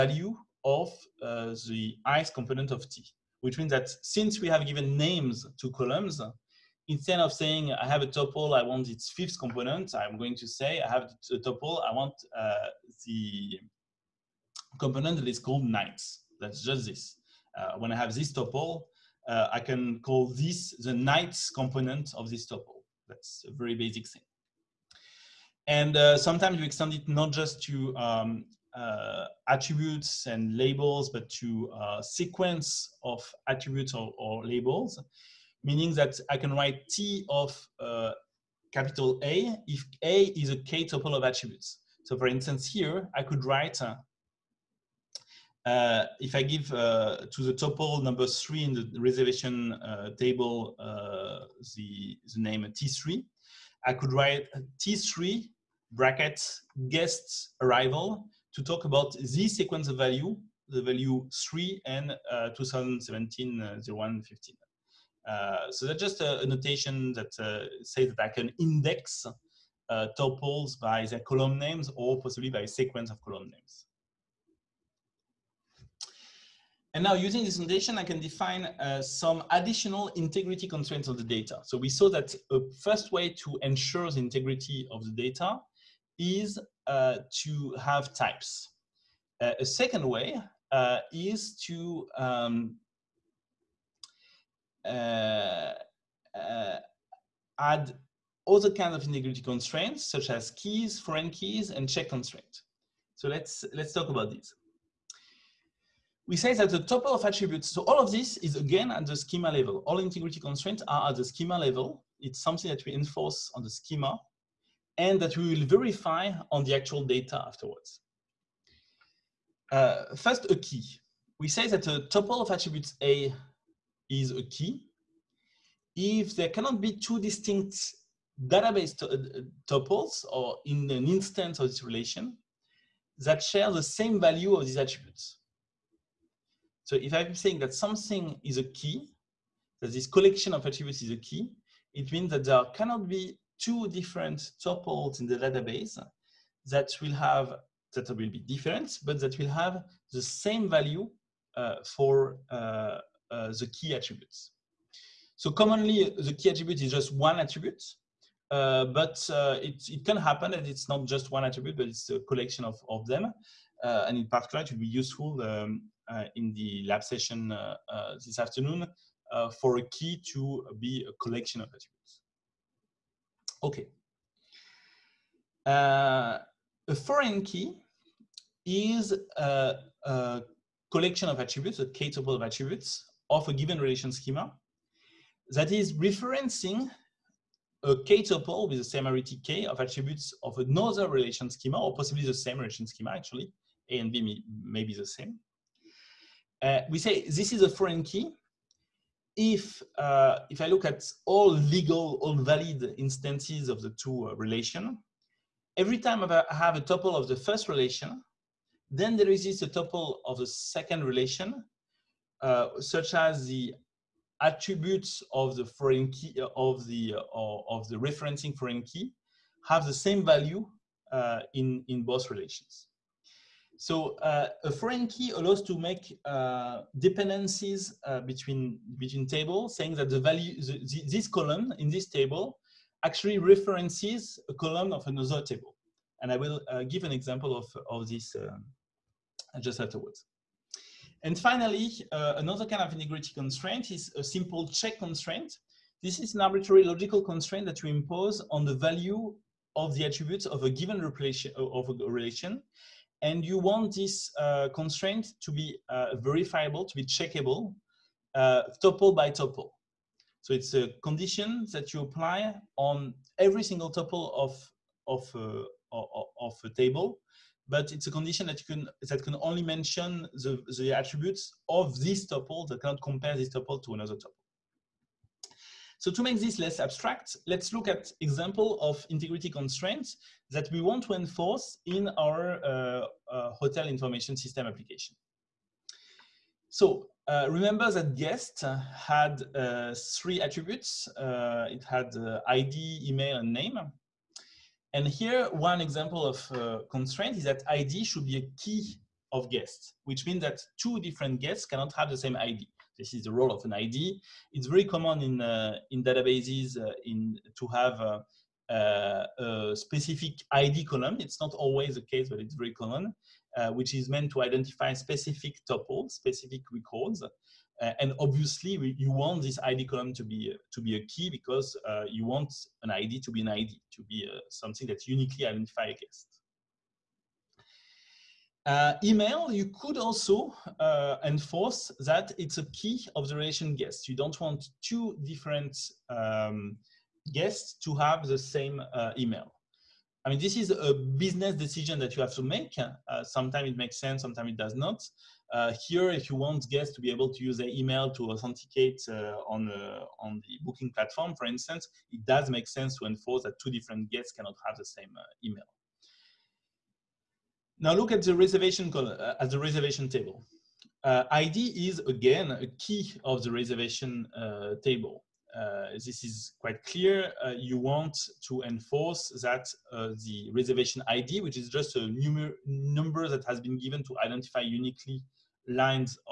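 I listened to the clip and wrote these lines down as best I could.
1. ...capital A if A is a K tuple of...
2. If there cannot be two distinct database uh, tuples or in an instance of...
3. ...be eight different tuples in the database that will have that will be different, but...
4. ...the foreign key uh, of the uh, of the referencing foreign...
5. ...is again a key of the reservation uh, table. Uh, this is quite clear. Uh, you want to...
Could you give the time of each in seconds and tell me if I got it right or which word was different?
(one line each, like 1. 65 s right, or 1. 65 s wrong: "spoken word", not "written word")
1. 38 s right
2. 125 s right
3. 143 s wrong: "two", not "eight"
4. 215 s right
5. 361 s right.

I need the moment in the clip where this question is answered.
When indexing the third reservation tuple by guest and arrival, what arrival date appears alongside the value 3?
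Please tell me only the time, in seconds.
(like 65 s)
62 s.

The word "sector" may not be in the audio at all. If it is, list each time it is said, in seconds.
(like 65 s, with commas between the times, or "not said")
not said.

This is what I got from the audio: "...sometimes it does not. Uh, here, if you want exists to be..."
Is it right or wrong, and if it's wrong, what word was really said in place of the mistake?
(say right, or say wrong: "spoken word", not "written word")
wrong: "guests", not "exists".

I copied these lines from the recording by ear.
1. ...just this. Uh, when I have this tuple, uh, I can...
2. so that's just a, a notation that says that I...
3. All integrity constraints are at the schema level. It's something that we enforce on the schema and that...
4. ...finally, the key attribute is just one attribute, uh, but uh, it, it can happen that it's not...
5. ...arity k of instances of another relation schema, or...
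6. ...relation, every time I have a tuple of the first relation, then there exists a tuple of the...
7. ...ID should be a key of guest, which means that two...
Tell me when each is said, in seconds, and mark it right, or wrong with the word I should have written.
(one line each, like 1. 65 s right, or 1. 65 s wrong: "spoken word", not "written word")
1. 16 s right
2. 65 s right
3. 109 s right
4. 155 s wrong: "commonly", not "finally"
5. 189 s wrong: "attributes", not "instances"
6. 204 s right
7. 297 s right.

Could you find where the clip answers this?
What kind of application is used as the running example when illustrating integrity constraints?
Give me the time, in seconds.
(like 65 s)
283 s.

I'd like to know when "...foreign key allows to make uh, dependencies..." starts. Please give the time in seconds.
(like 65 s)
224 s.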